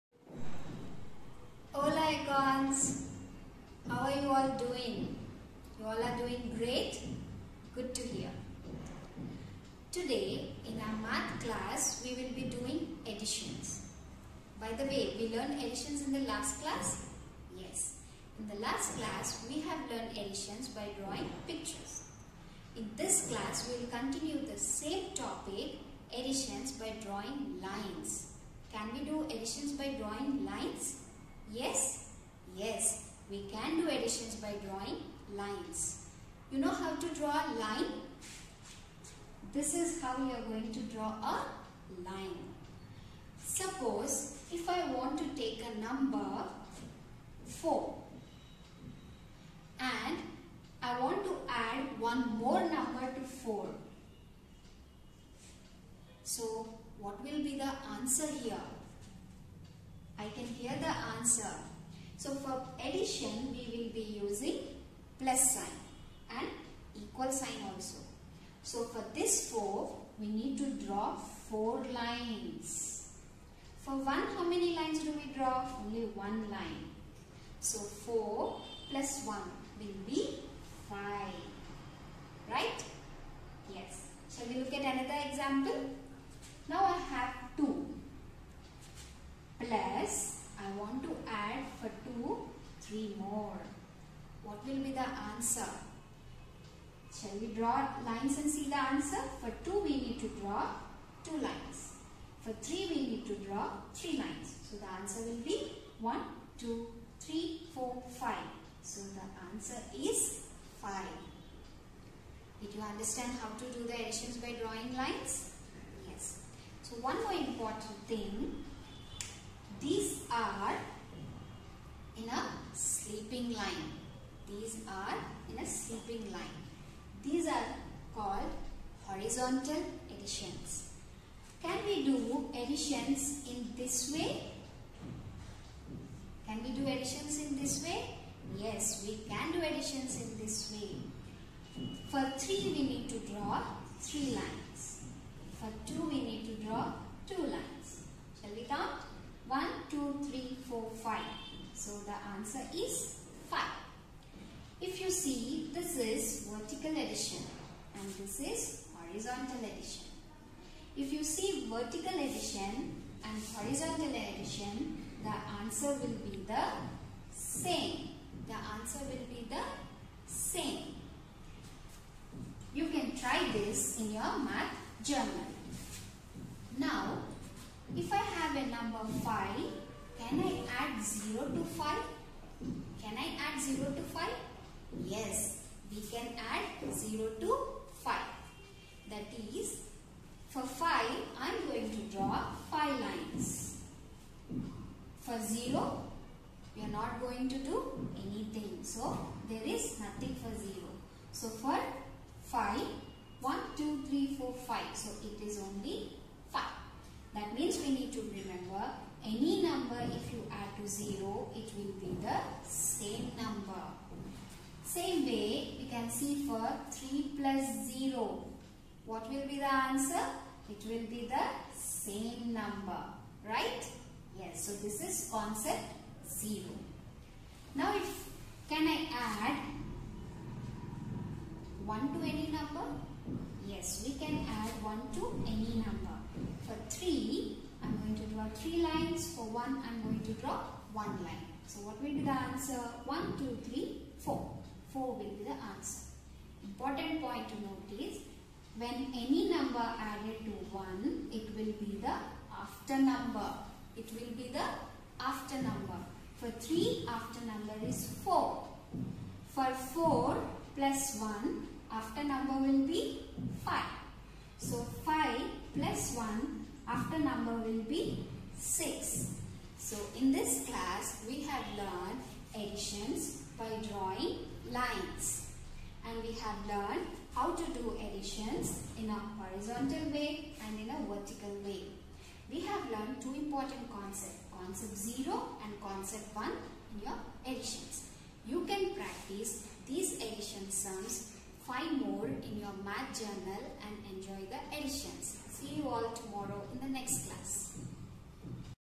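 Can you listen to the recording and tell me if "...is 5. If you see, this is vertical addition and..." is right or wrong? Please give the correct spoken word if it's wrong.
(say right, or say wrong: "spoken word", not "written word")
right.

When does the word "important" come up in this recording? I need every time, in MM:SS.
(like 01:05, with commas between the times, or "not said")
01:57, 04:06, 04:43.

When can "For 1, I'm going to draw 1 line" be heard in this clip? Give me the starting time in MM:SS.
03:59.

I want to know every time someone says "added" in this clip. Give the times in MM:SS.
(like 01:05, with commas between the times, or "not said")
04:10.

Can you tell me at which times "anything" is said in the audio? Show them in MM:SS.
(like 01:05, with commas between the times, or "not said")
03:18.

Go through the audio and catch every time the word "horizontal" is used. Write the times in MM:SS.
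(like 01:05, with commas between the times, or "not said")
02:09, 02:38, 02:43, 04:39.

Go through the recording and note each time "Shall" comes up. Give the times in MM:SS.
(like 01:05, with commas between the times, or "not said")
01:24, 01:37, 02:28.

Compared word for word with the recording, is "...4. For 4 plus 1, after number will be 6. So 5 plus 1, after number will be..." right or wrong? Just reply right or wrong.
wrong.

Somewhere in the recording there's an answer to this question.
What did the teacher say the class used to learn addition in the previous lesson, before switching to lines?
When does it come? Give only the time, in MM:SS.
00:20.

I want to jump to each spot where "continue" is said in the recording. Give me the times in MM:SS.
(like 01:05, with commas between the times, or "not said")
00:23.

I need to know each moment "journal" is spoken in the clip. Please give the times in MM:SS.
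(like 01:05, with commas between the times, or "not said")
02:55, 04:53.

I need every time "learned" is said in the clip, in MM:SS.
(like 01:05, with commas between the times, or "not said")
00:15, 00:19, 04:31, 04:36, 04:42.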